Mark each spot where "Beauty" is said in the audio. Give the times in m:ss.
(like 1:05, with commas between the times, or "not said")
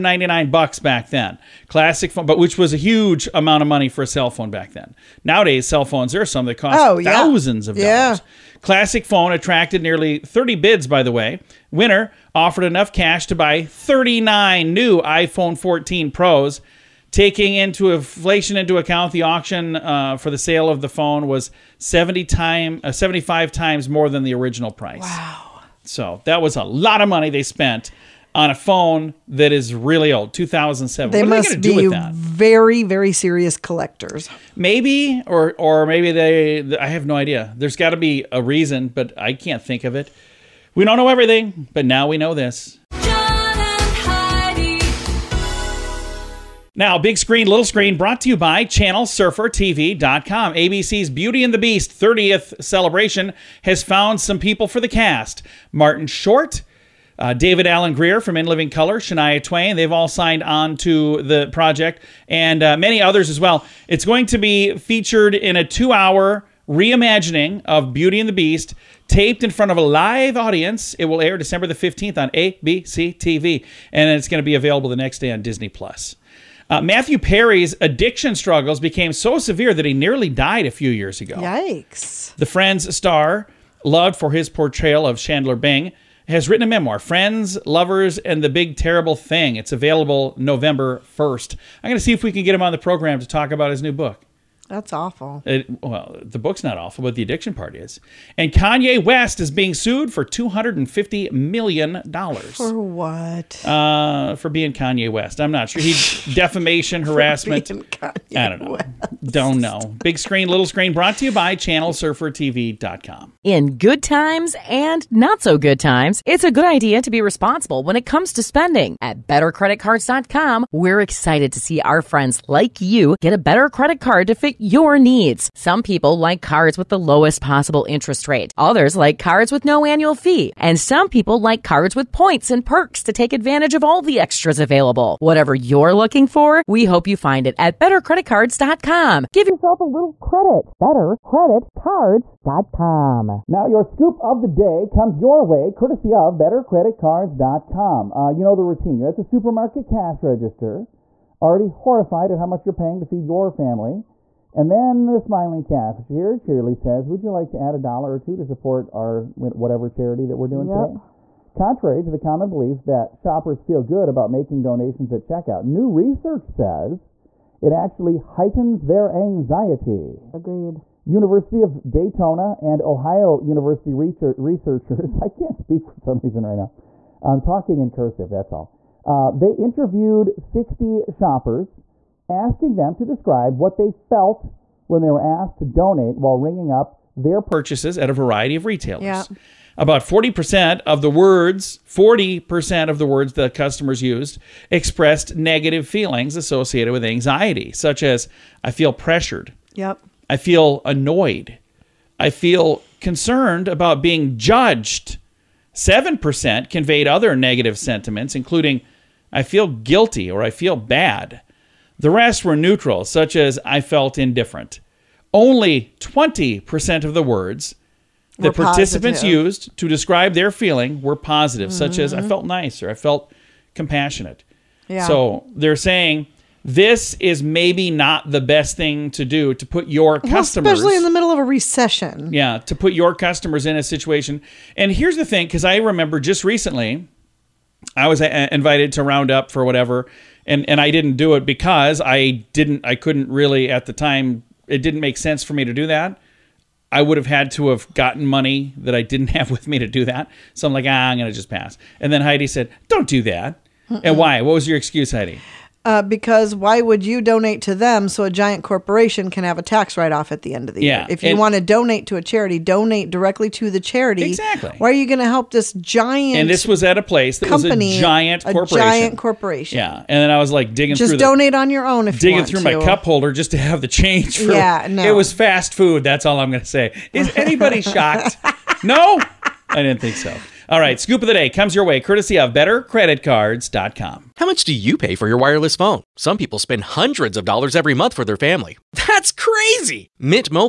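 0:51, 1:07.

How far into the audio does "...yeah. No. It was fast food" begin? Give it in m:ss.
4:34.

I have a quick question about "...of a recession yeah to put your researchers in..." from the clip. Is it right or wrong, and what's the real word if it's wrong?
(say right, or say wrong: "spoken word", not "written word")
wrong: "customers", not "researchers".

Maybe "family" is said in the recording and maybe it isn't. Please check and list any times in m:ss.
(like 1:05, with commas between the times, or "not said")
2:33, 4:48.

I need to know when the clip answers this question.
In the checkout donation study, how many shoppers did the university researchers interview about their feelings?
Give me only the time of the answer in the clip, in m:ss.
3:00.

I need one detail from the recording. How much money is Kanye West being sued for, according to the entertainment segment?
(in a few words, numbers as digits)
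$250 million.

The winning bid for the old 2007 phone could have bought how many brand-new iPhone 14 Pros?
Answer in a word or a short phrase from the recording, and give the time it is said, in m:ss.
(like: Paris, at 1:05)
39, at 0:13.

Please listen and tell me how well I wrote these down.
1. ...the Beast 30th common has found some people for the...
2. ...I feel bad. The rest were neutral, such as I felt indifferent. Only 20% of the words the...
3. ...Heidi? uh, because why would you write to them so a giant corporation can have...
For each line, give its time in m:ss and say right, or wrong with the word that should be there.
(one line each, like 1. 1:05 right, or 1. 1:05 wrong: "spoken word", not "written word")
1. 0:51 wrong: "celebration", not "common"
2. 3:30 right
3. 4:15 wrong: "donate", not "write".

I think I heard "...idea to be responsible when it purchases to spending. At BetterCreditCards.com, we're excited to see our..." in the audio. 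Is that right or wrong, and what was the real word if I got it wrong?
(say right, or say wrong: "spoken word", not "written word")
wrong: "comes", not "purchases".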